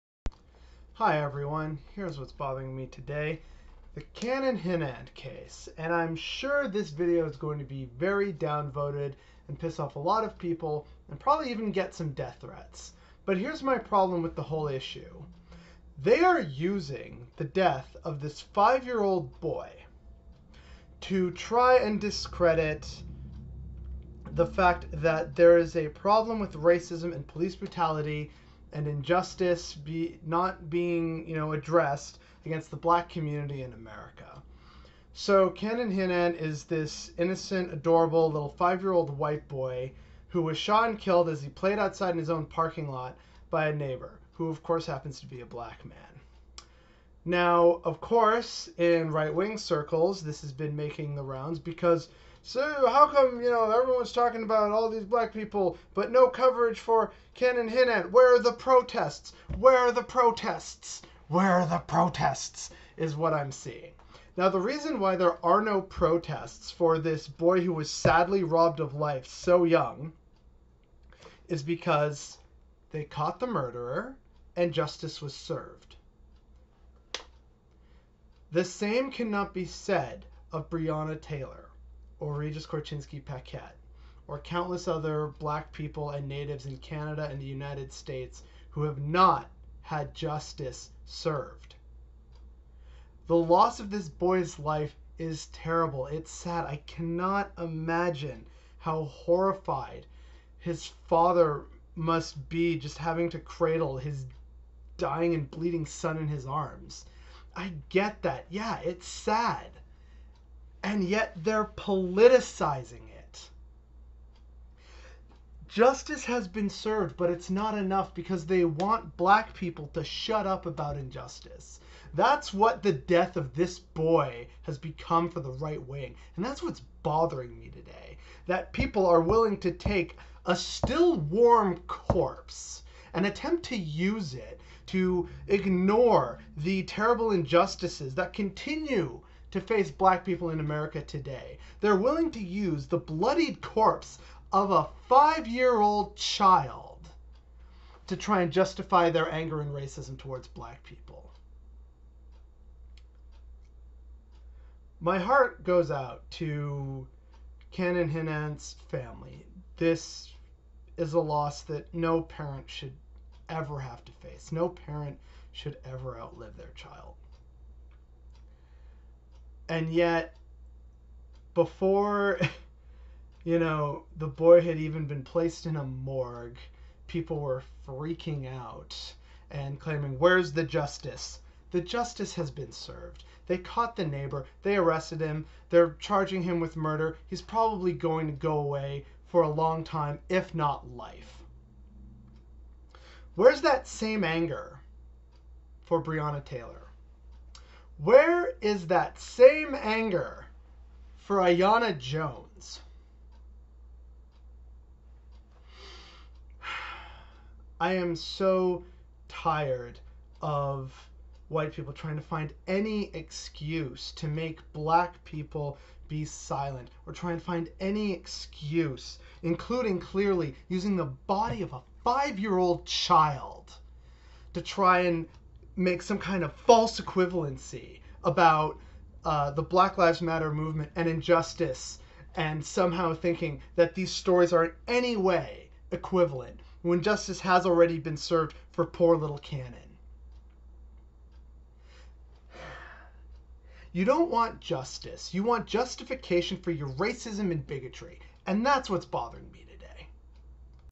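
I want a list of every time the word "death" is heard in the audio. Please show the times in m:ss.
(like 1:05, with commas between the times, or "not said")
0:12, 0:17, 2:02.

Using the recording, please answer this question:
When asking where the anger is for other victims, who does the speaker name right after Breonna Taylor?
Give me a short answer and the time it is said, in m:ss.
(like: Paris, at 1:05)
Aiyana Jones, at 3:21.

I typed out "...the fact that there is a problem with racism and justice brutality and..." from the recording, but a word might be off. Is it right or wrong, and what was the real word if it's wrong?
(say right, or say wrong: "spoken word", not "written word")
wrong: "police", not "justice".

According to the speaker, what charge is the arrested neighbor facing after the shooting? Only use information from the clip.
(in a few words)
Murder.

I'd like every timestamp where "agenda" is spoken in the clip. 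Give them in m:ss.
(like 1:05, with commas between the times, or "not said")
not said.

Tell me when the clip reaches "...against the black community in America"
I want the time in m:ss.
0:32.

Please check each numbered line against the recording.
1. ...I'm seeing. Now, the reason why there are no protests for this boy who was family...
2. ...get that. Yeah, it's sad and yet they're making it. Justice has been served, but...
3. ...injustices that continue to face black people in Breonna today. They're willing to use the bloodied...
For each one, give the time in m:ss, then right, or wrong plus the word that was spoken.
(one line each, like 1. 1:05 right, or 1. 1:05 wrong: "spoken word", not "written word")
1. 1:03 wrong: "sadly", not "family"
2. 1:47 wrong: "politicizing", not "making"
3. 2:17 wrong: "America", not "Breonna".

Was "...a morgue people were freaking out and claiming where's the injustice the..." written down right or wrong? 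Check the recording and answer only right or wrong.
wrong.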